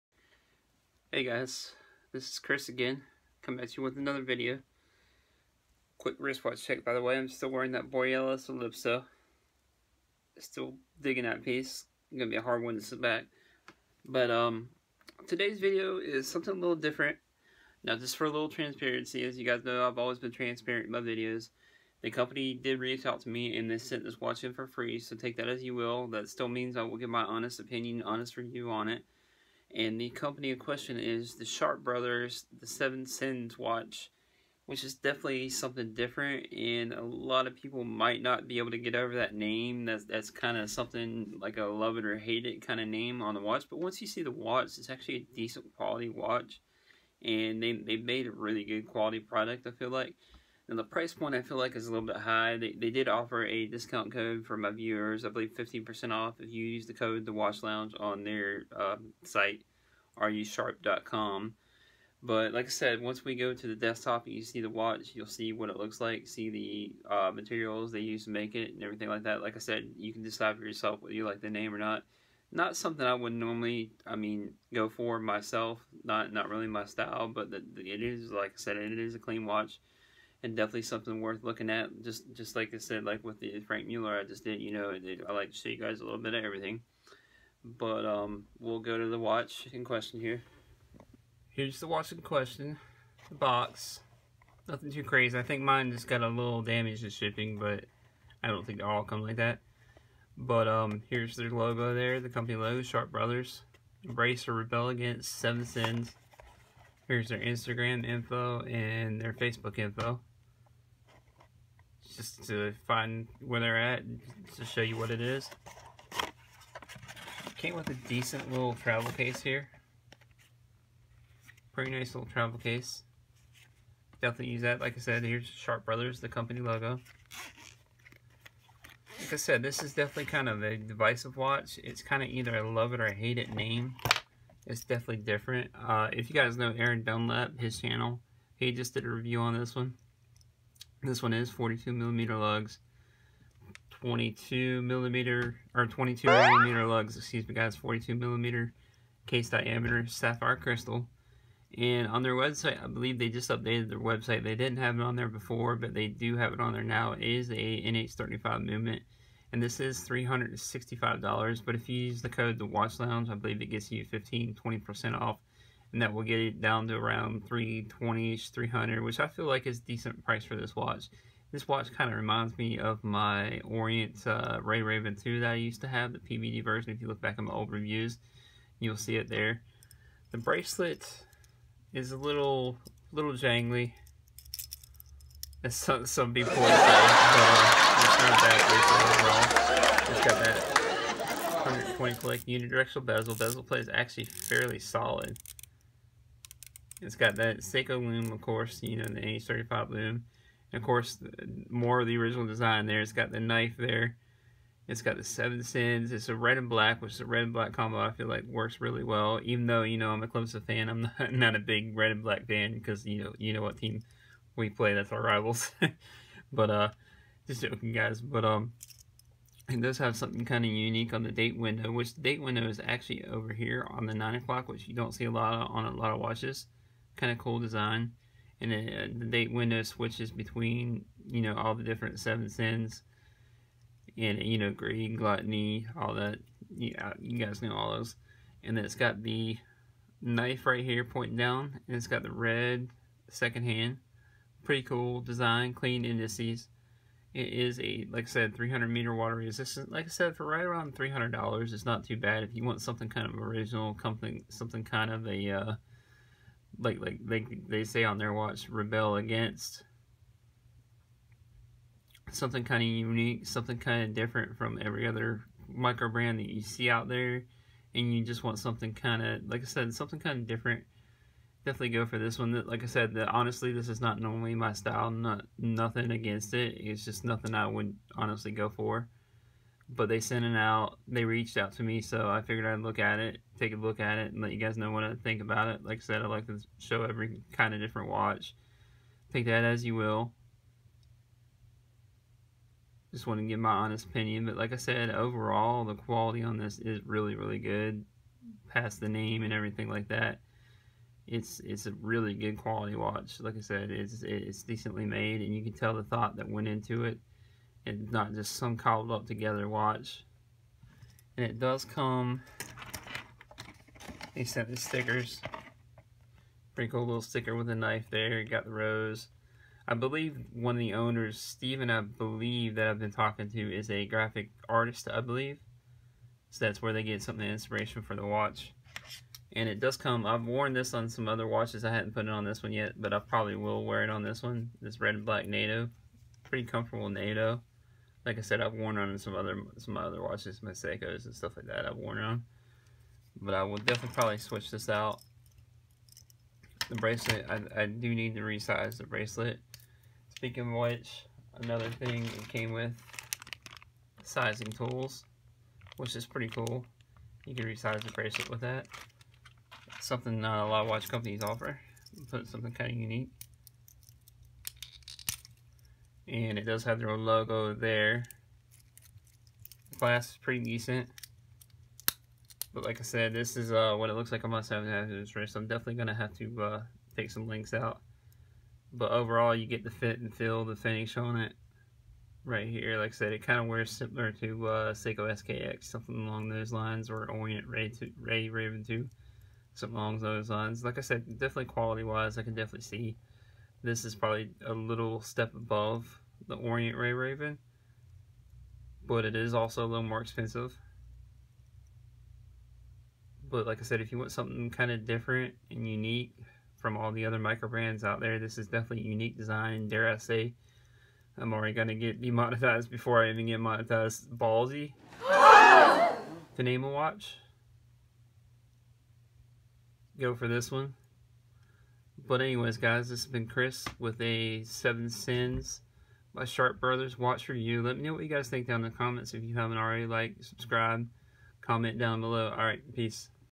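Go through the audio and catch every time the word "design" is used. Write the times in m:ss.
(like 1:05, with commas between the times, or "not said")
3:22, 3:47, 4:05, 6:49.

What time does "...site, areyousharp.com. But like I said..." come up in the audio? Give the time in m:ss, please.
0:59.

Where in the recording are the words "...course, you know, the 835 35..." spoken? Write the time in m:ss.
3:18.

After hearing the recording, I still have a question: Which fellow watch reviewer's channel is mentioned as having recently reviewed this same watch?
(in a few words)
Aaron Dunlap.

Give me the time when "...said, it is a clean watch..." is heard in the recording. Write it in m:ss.
1:18.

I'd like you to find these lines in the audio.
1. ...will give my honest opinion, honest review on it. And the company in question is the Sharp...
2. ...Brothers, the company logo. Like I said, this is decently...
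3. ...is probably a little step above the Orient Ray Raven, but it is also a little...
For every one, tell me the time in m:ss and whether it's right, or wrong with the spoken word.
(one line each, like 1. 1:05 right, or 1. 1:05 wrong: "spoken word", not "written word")
1. 0:26 right
2. 2:05 wrong: "definitely", not "decently"
3. 6:34 right.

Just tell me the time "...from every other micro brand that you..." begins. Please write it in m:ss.
4:24.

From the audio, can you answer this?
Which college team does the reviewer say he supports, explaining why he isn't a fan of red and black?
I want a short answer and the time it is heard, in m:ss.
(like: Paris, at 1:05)
Clemson, at 3:30.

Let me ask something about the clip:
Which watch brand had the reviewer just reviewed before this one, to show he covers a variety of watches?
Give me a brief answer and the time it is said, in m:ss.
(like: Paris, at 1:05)
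Franck Muller, at 1:23.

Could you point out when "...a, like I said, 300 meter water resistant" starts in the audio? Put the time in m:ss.
4:07.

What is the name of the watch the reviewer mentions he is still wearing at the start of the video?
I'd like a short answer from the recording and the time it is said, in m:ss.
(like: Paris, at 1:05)
Borealis Ellipso, at 0:07.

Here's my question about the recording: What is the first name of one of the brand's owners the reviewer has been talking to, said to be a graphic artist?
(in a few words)
Steven.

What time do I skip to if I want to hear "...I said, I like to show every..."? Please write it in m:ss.
4:45.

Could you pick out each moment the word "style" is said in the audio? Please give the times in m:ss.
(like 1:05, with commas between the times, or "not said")
1:16, 4:34.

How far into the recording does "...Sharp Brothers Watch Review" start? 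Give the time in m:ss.
7:06.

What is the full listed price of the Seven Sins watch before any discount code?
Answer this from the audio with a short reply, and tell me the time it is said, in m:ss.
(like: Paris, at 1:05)
$365, at 2:40.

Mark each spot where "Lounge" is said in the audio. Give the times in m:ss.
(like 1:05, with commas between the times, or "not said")
0:57, 2:42.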